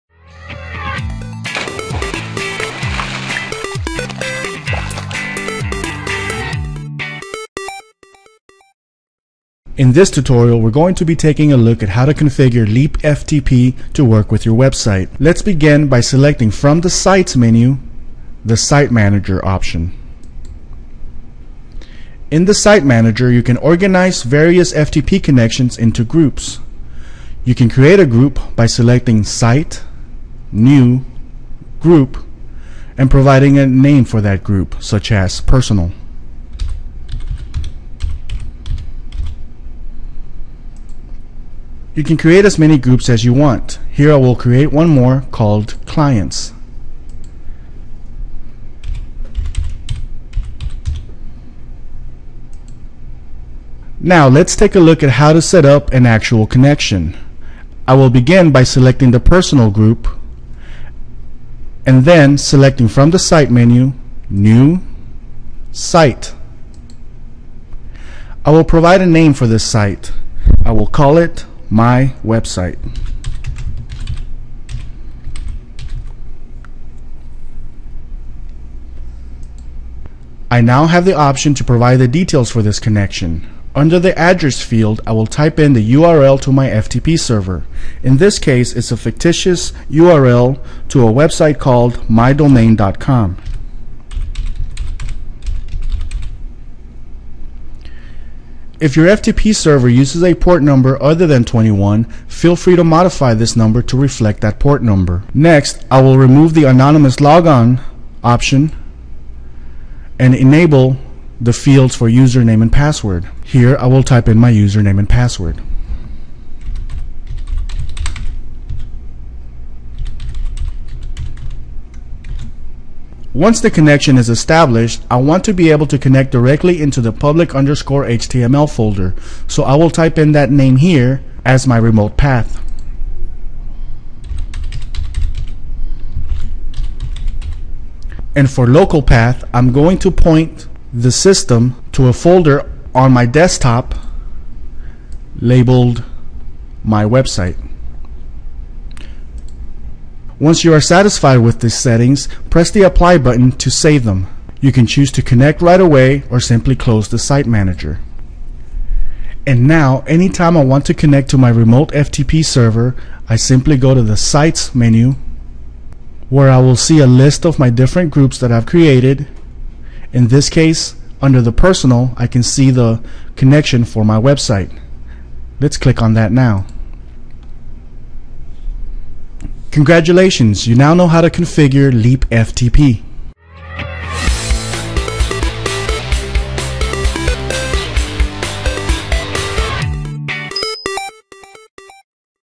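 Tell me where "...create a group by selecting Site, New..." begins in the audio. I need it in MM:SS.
00:27.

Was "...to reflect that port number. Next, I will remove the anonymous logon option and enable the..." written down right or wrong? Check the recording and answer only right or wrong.
right.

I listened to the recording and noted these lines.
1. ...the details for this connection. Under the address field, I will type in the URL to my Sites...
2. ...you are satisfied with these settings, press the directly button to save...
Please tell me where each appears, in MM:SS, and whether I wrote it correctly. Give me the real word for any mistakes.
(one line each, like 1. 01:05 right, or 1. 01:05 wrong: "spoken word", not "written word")
1. 01:21 wrong: "FTP", not "Sites"
2. 02:30 wrong: "apply", not "directly".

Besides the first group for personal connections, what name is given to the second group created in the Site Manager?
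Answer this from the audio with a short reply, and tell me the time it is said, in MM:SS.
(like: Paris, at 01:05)
clients, at 00:45.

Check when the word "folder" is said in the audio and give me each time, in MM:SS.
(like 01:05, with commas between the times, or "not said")
02:08, 02:22.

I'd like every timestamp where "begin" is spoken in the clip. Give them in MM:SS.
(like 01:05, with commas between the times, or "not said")
00:15, 00:58.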